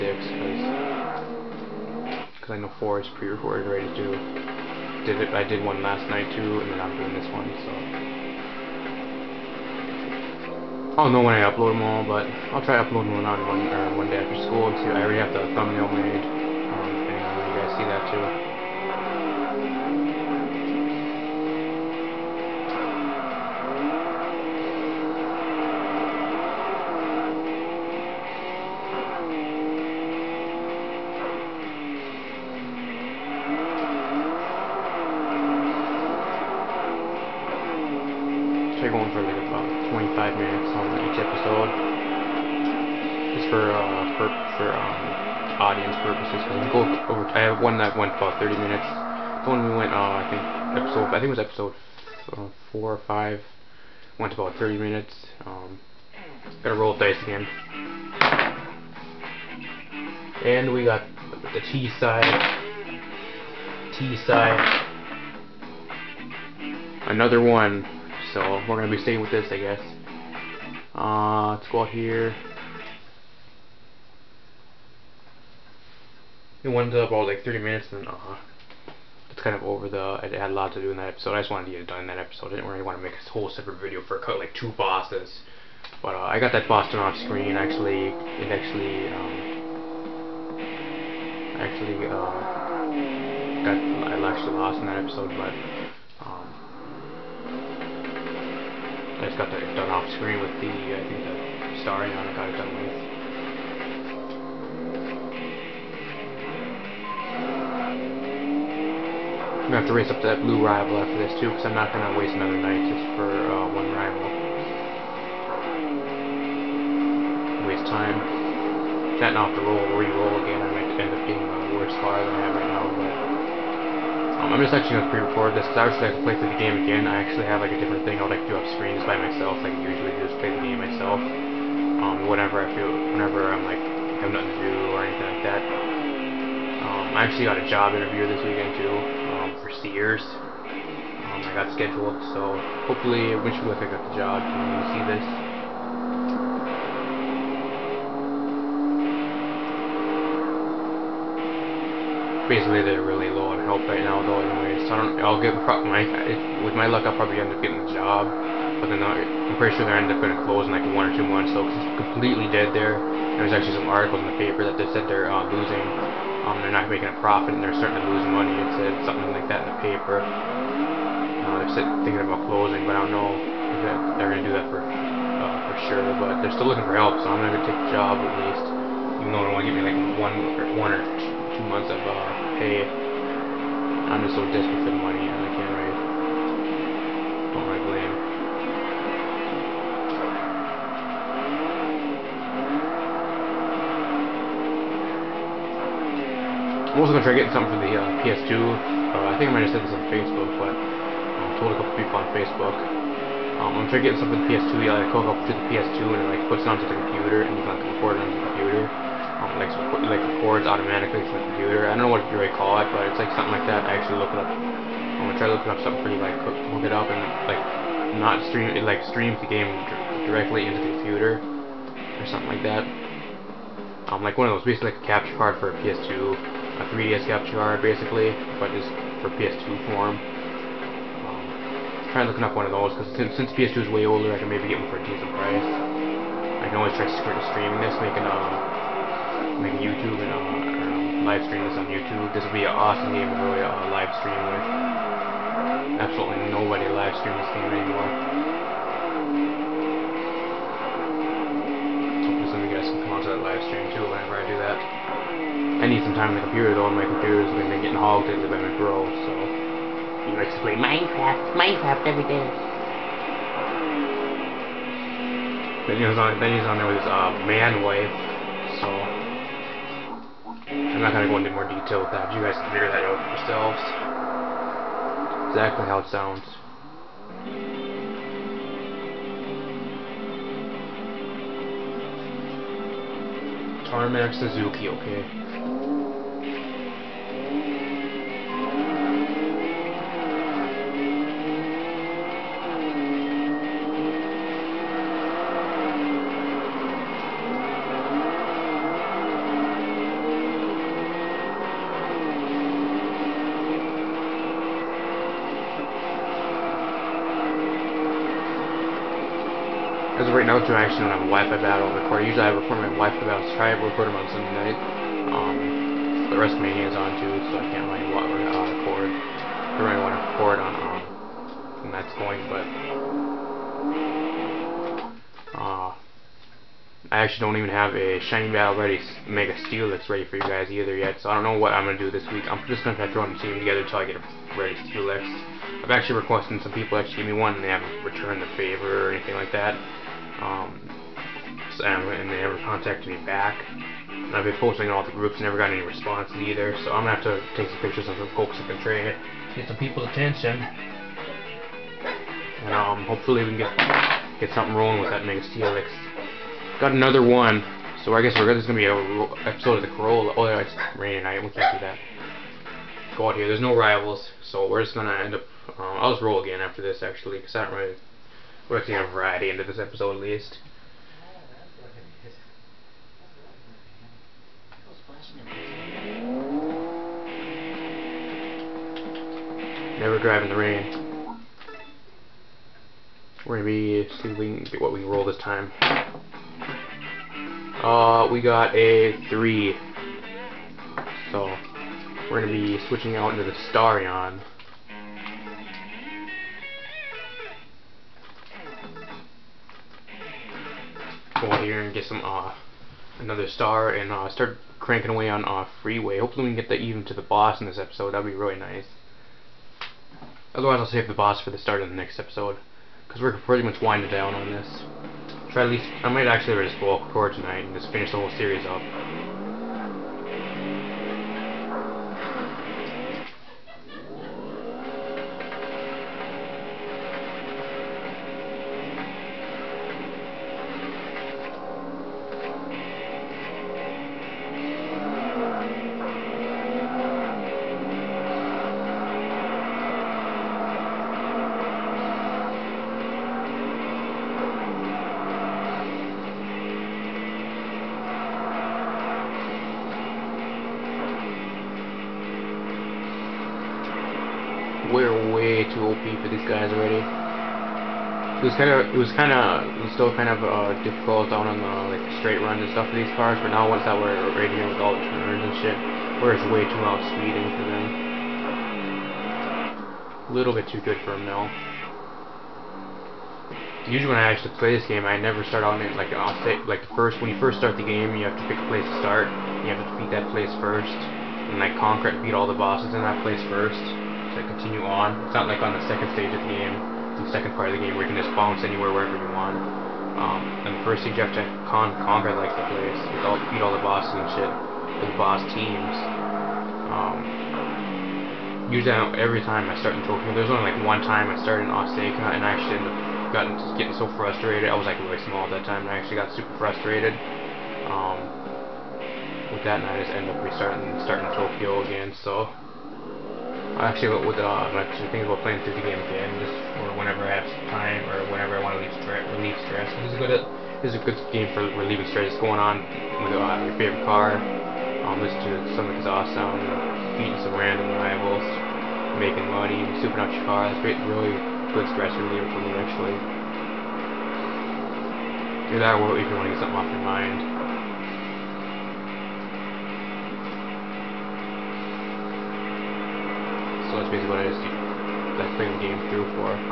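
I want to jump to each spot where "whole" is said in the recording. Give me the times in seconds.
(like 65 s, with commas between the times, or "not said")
83 s, 418 s.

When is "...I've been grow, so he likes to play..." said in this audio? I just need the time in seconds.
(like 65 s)
258 s.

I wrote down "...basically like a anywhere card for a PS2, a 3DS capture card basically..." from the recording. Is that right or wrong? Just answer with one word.
wrong.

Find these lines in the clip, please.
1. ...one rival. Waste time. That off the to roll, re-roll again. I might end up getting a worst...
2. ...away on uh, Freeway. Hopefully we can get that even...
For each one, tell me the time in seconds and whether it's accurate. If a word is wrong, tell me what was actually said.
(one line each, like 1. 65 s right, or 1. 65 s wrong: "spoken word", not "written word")
1. 113 s right
2. 405 s right.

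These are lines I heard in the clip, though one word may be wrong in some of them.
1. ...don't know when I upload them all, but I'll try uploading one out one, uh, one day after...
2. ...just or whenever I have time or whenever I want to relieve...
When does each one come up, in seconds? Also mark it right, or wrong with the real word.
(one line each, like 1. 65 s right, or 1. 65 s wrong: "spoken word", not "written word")
1. 10 s right
2. 516 s right.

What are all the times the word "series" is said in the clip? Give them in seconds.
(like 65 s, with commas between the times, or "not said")
418 s.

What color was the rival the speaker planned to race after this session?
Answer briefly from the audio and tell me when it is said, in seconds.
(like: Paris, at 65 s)
blue, at 110 s.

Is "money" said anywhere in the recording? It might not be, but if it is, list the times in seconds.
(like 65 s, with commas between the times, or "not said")
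168 s, 185 s, 529 s.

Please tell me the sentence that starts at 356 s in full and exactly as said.
Got another one, so I guess we're there's gonna be a episode of the Corolla.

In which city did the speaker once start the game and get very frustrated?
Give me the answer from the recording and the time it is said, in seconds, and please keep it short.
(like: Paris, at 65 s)
Osaka, at 501 s.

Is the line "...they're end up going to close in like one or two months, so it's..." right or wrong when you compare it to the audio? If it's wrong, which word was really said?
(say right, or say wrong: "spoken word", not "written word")
right.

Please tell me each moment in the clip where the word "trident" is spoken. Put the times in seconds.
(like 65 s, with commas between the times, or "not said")
not said.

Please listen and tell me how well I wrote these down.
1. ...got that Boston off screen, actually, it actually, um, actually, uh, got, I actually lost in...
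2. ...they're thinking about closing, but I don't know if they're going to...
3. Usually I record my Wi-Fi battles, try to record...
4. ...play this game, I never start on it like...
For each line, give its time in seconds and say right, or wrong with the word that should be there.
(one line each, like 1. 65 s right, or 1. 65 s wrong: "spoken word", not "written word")
1. 86 s right
2. 171 s right
3. 312 s right
4. 474 s right.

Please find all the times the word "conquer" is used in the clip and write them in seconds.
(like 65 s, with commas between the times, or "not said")
481 s, 492 s.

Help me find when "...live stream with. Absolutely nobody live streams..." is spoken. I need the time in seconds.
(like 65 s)
243 s.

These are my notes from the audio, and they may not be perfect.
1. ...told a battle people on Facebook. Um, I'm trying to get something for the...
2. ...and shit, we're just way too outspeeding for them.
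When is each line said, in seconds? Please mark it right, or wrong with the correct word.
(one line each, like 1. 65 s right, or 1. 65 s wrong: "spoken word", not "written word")
1. 201 s wrong: "couple", not "battle"
2. 465 s right.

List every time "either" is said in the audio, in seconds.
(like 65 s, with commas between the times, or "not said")
330 s, 346 s.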